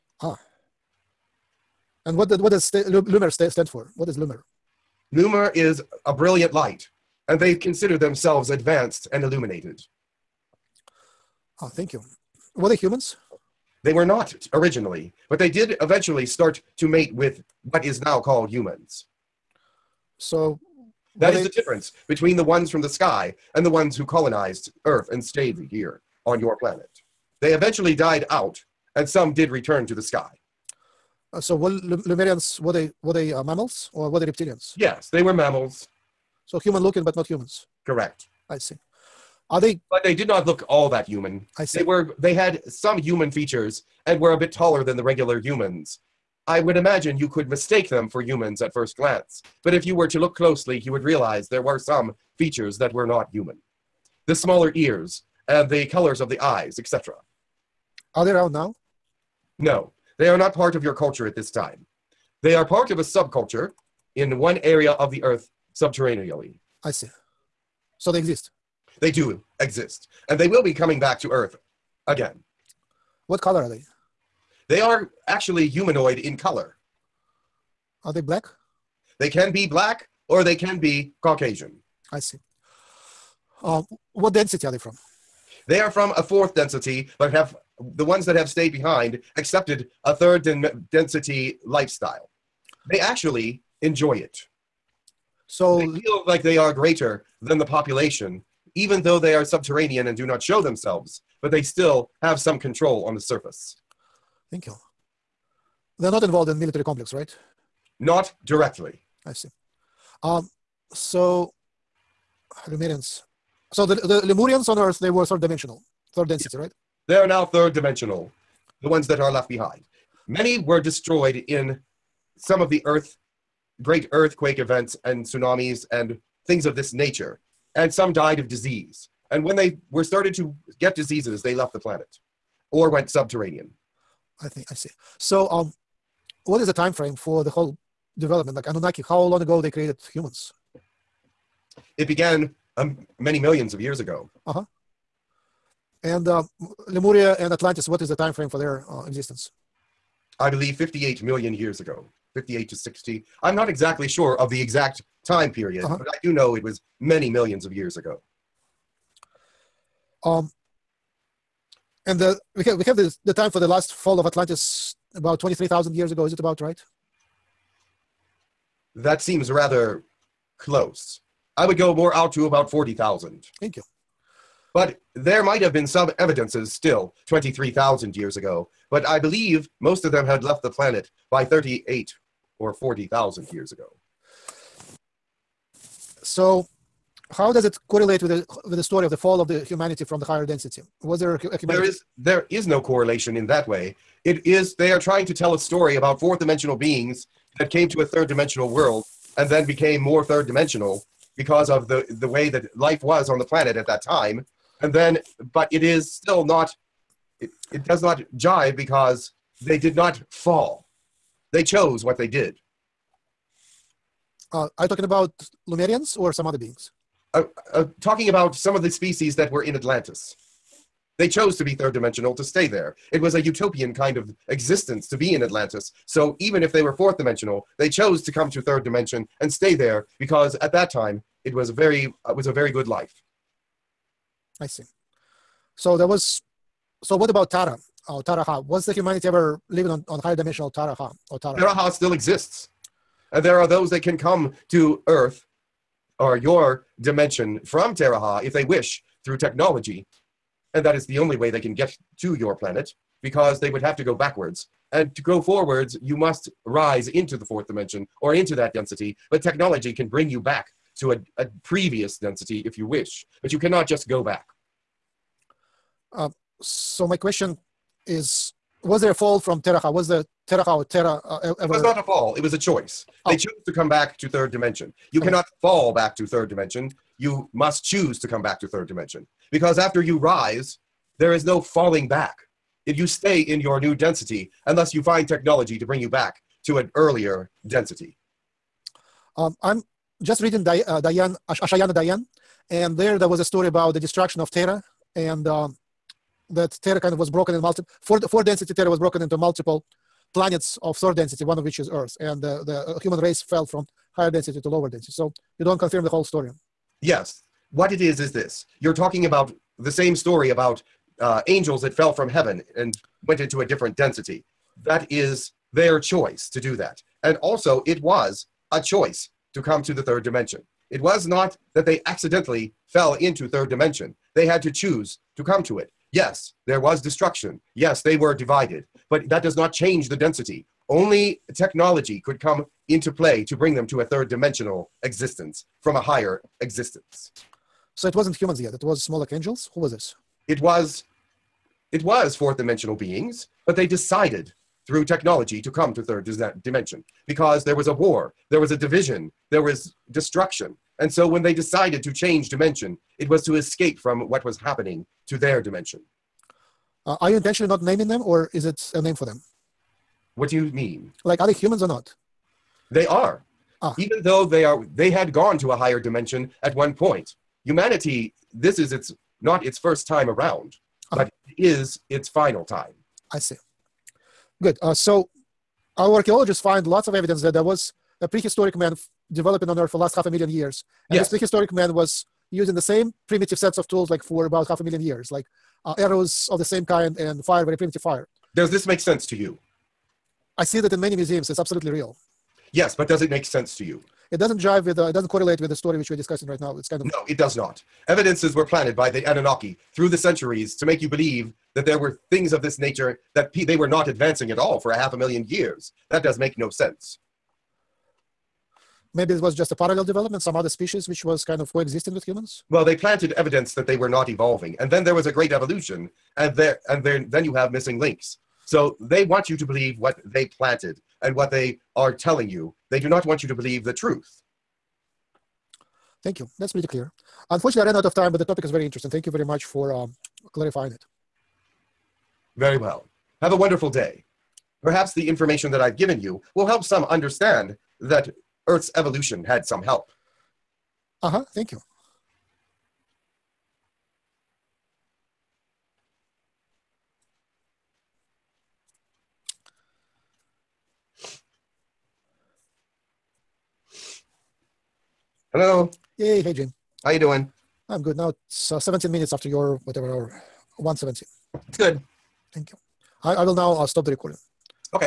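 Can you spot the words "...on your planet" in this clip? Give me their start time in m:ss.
0:26.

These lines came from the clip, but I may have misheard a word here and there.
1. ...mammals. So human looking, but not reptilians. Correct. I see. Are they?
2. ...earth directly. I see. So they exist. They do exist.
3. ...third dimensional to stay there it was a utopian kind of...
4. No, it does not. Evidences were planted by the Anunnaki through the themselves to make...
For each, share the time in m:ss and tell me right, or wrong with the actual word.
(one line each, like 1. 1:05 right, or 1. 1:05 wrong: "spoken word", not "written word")
1. 0:35 wrong: "humans", not "reptilians"
2. 1:05 wrong: "subterraneally", not "directly"
3. 3:41 right
4. 6:37 wrong: "centuries", not "themselves".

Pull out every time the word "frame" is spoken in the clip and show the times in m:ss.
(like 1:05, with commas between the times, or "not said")
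2:16, 2:28.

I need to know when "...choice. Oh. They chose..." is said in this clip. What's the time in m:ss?
4:32.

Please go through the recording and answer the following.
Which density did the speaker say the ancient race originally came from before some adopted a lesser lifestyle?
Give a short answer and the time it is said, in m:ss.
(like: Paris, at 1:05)
fourth density, at 1:26.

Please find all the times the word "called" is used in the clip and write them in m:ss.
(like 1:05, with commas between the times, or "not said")
0:18.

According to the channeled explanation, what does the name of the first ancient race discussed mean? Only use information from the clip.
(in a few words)
brilliant light.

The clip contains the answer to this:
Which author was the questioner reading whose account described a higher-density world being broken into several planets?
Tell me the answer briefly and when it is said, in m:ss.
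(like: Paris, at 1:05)
Ashayana Deane, at 4:51.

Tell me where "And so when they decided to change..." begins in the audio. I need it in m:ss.
5:50.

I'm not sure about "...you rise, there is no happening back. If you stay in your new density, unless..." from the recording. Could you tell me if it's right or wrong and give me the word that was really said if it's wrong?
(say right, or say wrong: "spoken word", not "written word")
wrong: "falling", not "happening".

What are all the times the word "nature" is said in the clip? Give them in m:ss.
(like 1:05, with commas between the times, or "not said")
2:06, 6:42.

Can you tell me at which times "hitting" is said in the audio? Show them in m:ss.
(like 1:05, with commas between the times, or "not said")
not said.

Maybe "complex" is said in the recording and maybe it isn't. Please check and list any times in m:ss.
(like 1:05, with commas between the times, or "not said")
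1:46.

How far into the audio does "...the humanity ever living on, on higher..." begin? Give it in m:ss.
3:58.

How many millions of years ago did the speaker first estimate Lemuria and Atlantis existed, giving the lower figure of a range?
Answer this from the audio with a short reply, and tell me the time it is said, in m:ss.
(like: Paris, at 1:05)
58 million years, at 2:30.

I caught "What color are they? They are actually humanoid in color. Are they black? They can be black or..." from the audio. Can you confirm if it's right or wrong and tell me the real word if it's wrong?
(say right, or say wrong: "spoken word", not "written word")
right.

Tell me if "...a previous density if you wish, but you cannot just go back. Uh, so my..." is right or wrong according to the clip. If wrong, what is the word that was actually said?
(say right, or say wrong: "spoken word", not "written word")
right.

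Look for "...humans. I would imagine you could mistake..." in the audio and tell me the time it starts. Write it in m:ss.
0:45.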